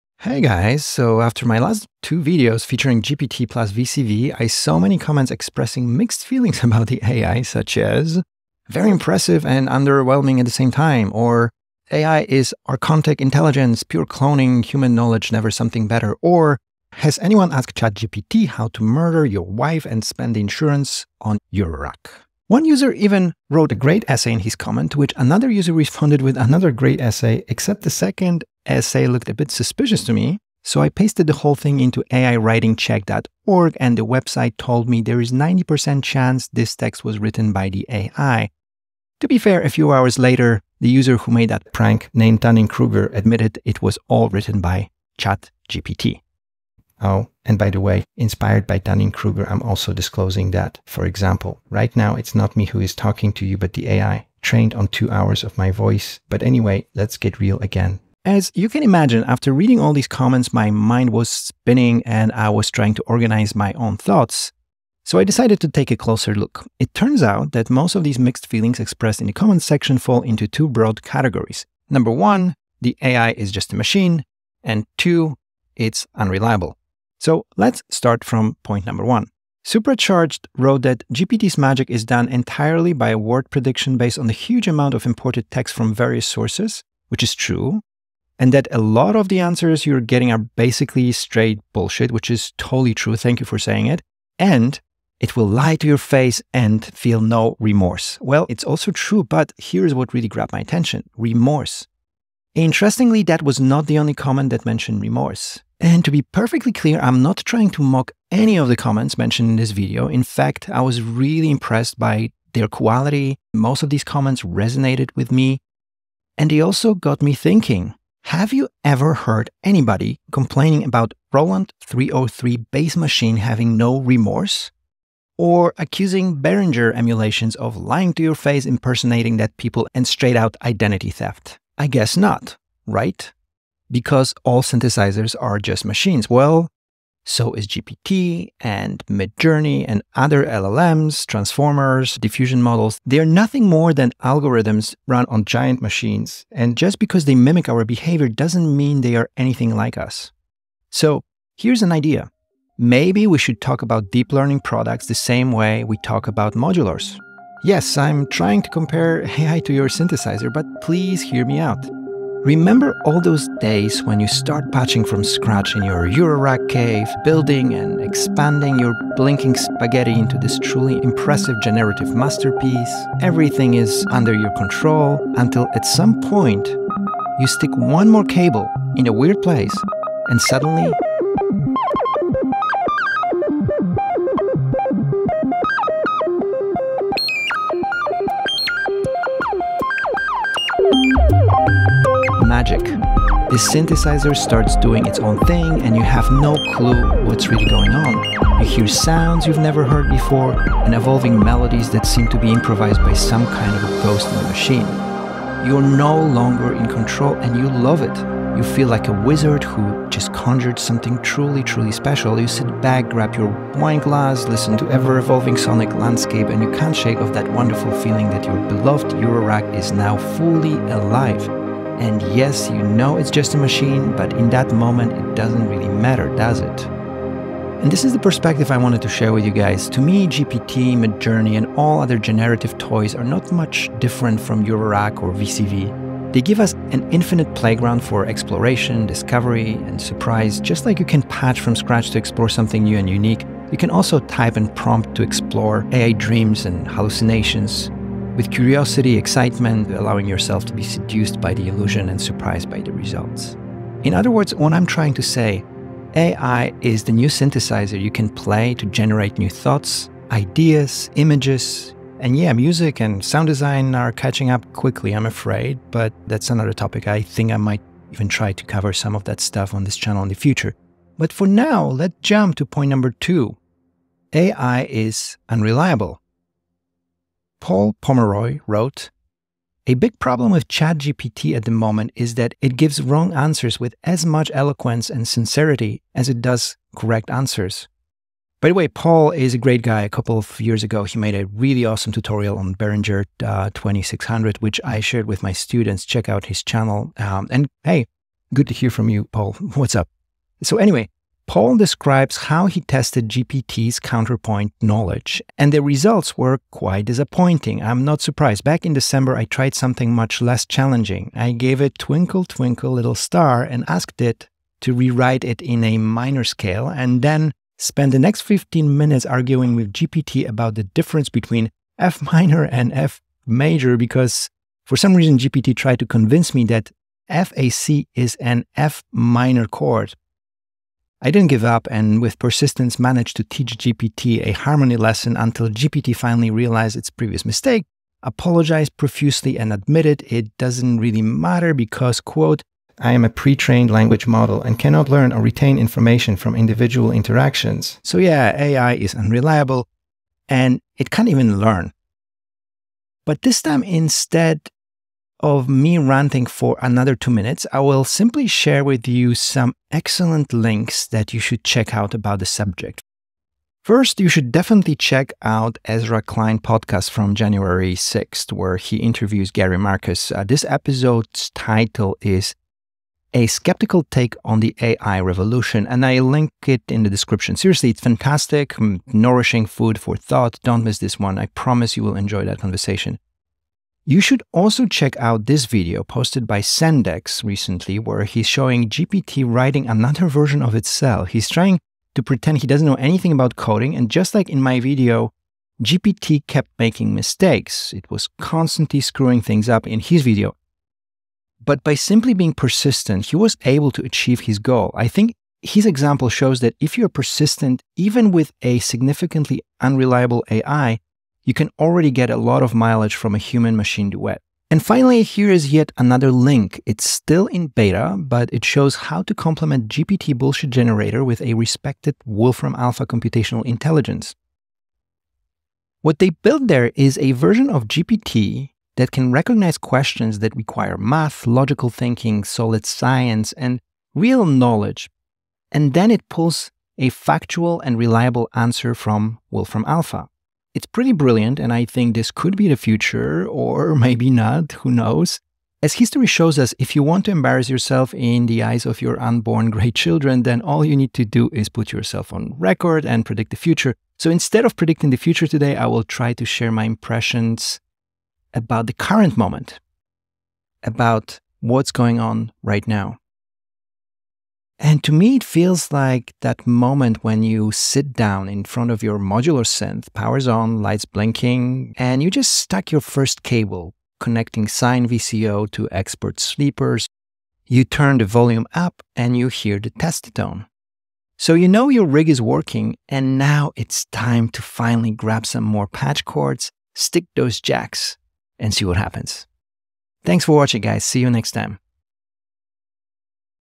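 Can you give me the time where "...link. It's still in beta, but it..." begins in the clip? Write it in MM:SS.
06:56.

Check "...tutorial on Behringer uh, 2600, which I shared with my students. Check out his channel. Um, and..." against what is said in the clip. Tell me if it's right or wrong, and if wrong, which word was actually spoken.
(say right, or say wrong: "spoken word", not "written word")
right.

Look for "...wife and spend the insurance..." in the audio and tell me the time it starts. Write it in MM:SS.
00:19.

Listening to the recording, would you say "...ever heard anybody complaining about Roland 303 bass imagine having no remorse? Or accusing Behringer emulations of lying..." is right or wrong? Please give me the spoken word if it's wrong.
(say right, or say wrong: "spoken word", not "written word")
wrong: "machine", not "imagine".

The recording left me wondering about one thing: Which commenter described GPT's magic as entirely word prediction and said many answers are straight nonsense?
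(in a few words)
Supercharged.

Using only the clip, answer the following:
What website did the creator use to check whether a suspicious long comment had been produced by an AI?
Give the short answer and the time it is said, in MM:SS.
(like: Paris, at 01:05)
AIWritingCheck.org, at 00:32.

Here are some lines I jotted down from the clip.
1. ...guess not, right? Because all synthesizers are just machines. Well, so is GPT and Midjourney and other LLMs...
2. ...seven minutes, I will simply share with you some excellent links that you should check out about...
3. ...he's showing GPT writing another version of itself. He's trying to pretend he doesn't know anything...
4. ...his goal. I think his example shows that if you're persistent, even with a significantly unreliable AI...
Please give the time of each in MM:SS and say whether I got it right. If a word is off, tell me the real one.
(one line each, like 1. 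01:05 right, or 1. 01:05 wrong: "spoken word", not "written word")
1. 02:11 right
2. 05:57 wrong: "two", not "seven"
3. 06:28 right
4. 06:44 right.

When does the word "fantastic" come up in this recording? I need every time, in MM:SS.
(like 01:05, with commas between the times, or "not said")
06:18.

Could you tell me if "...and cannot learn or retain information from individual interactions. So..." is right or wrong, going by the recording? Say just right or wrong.
right.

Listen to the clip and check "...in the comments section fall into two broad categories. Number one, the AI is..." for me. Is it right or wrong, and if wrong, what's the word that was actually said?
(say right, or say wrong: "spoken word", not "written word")
right.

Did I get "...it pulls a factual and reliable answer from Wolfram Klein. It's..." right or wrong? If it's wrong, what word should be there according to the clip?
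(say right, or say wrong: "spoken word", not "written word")
wrong: "Alpha", not "Klein".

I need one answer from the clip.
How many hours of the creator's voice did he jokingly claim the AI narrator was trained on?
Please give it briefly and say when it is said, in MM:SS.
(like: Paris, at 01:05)
2 hours, at 00:54.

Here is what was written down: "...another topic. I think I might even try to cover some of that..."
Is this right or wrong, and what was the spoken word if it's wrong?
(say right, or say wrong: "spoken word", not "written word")
right.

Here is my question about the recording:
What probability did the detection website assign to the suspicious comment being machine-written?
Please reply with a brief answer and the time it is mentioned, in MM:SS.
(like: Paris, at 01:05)
90%, at 00:35.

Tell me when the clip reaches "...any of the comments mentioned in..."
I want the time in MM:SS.
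01:48.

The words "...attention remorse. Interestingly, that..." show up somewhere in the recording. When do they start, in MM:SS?
01:40.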